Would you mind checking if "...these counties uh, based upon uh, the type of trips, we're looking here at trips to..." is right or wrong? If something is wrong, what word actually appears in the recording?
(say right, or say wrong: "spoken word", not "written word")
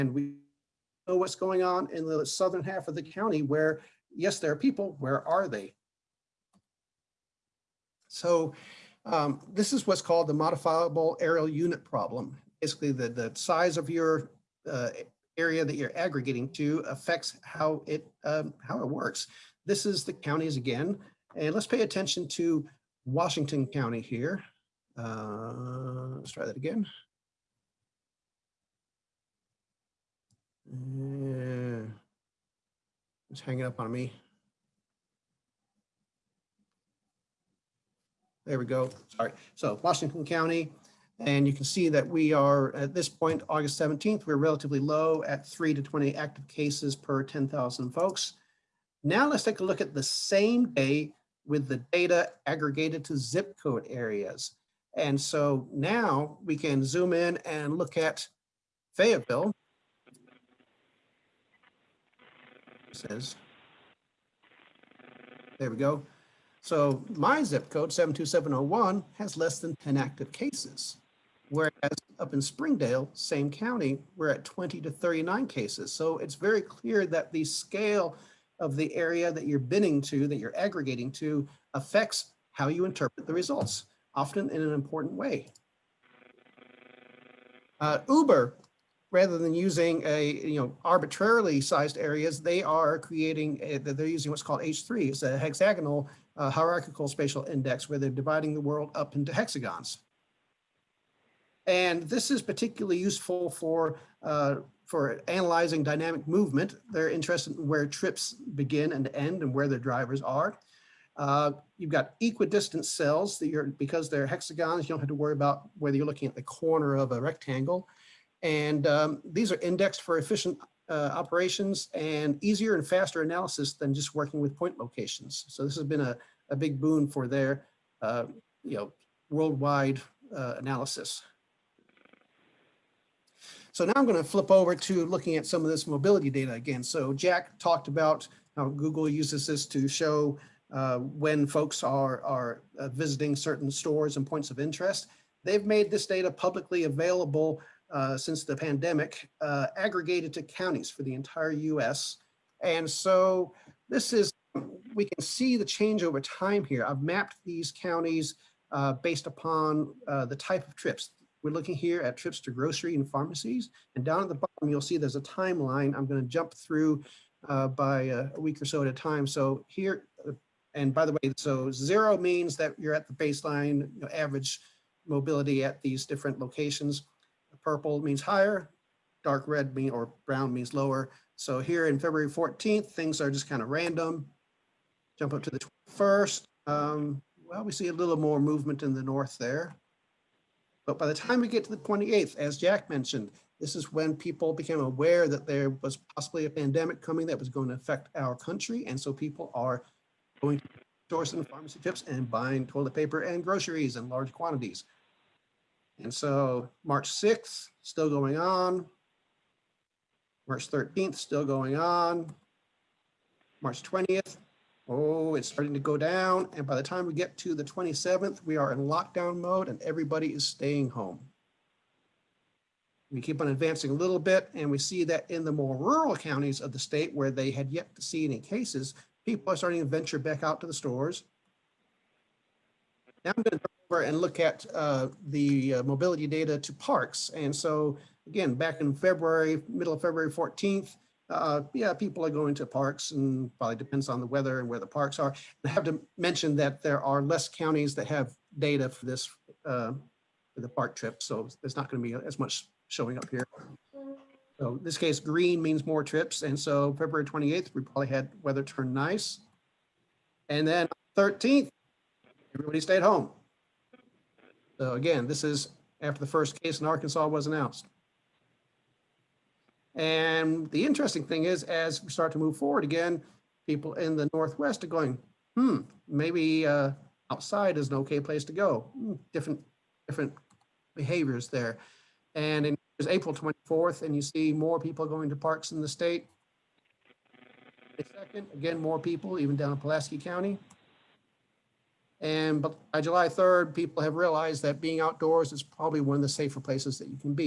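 right.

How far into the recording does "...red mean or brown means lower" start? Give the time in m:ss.
2:59.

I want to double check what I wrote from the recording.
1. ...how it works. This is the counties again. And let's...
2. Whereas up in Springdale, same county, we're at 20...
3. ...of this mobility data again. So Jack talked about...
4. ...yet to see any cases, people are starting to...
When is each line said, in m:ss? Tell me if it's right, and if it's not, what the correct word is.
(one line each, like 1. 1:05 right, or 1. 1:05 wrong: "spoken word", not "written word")
1. 0:18 right
2. 1:11 right
3. 2:15 right
4. 3:47 right.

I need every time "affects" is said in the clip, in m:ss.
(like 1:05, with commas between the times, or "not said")
0:16, 1:21, 3:17.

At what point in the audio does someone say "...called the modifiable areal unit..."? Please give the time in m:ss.
0:10.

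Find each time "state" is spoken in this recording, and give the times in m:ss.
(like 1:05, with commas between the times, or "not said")
3:46, 4:45.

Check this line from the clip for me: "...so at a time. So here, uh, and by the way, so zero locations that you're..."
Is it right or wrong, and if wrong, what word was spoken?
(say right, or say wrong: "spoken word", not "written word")
wrong: "means", not "locations".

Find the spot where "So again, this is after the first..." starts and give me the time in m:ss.
4:24.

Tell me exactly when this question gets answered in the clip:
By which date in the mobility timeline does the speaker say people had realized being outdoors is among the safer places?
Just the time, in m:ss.
4:53.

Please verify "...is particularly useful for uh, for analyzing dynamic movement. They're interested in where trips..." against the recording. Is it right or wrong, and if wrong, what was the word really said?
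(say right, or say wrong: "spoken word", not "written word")
right.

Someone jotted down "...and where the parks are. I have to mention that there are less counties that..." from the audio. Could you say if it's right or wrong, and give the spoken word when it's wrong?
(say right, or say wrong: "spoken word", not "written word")
right.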